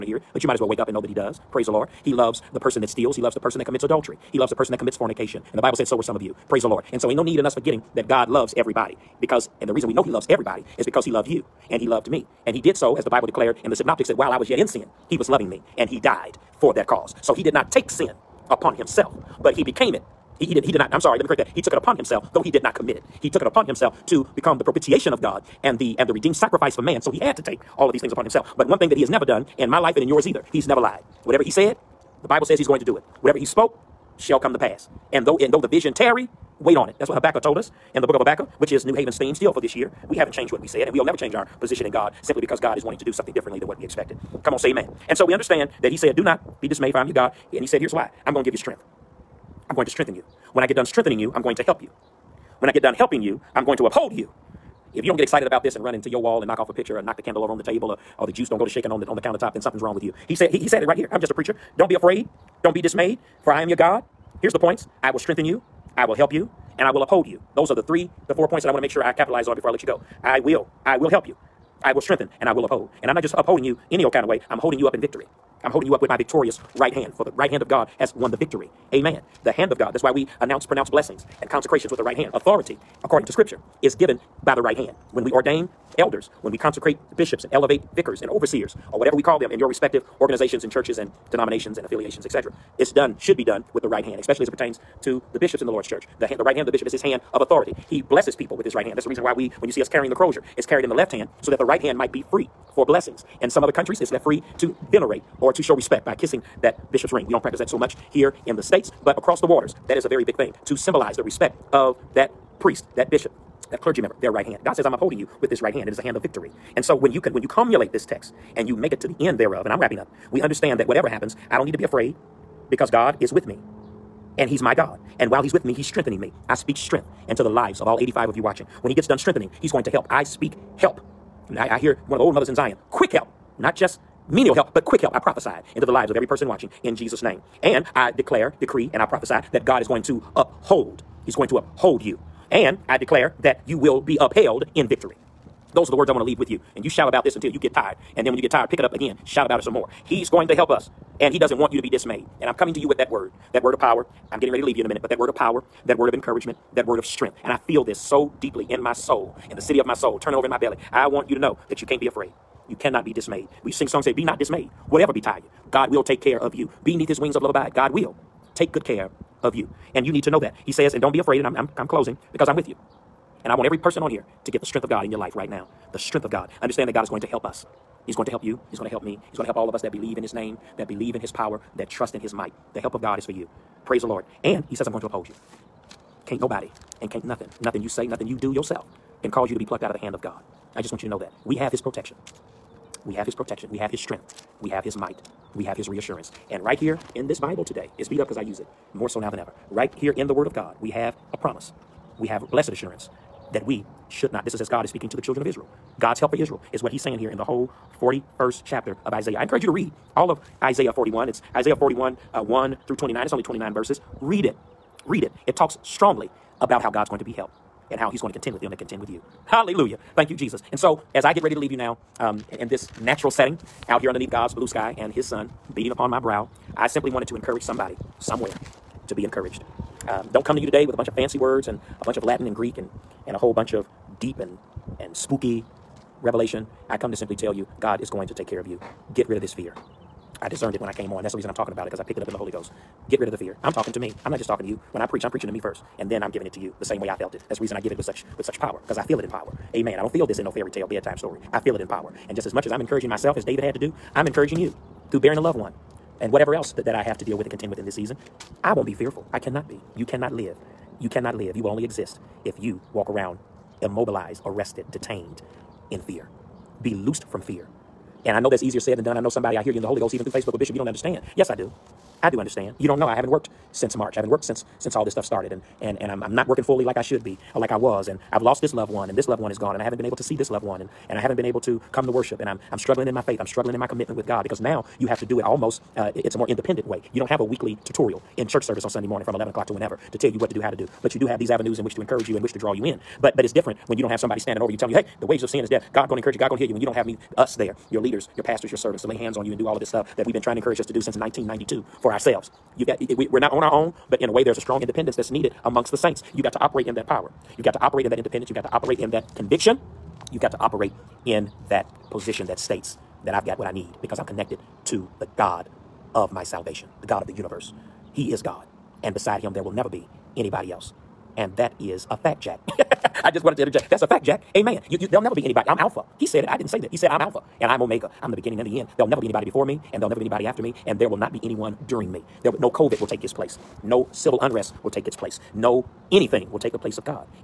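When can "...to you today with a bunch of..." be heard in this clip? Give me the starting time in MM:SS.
03:50.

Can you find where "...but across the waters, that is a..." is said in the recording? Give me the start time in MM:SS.
01:49.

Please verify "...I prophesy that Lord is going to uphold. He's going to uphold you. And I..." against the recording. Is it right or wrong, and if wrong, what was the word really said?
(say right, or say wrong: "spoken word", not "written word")
wrong: "God", not "Lord".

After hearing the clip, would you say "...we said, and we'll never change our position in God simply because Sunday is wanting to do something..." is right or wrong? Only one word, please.
wrong.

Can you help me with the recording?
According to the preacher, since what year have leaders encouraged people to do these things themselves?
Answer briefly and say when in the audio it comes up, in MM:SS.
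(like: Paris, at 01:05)
1992, at 05:01.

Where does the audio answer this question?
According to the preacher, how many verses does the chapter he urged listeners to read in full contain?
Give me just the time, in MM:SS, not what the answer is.
03:33.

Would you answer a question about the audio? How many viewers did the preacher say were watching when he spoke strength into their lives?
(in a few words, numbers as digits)
85.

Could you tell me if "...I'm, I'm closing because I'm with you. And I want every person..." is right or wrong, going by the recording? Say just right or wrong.
right.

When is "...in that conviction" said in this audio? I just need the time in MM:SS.
05:08.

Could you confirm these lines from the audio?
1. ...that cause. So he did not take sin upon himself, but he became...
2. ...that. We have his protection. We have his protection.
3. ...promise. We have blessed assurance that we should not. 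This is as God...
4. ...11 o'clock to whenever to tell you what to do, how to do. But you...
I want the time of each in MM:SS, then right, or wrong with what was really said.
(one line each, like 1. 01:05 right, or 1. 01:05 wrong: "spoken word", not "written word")
1. 00:16 right
2. 03:11 right
3. 03:21 right
4. 04:49 right.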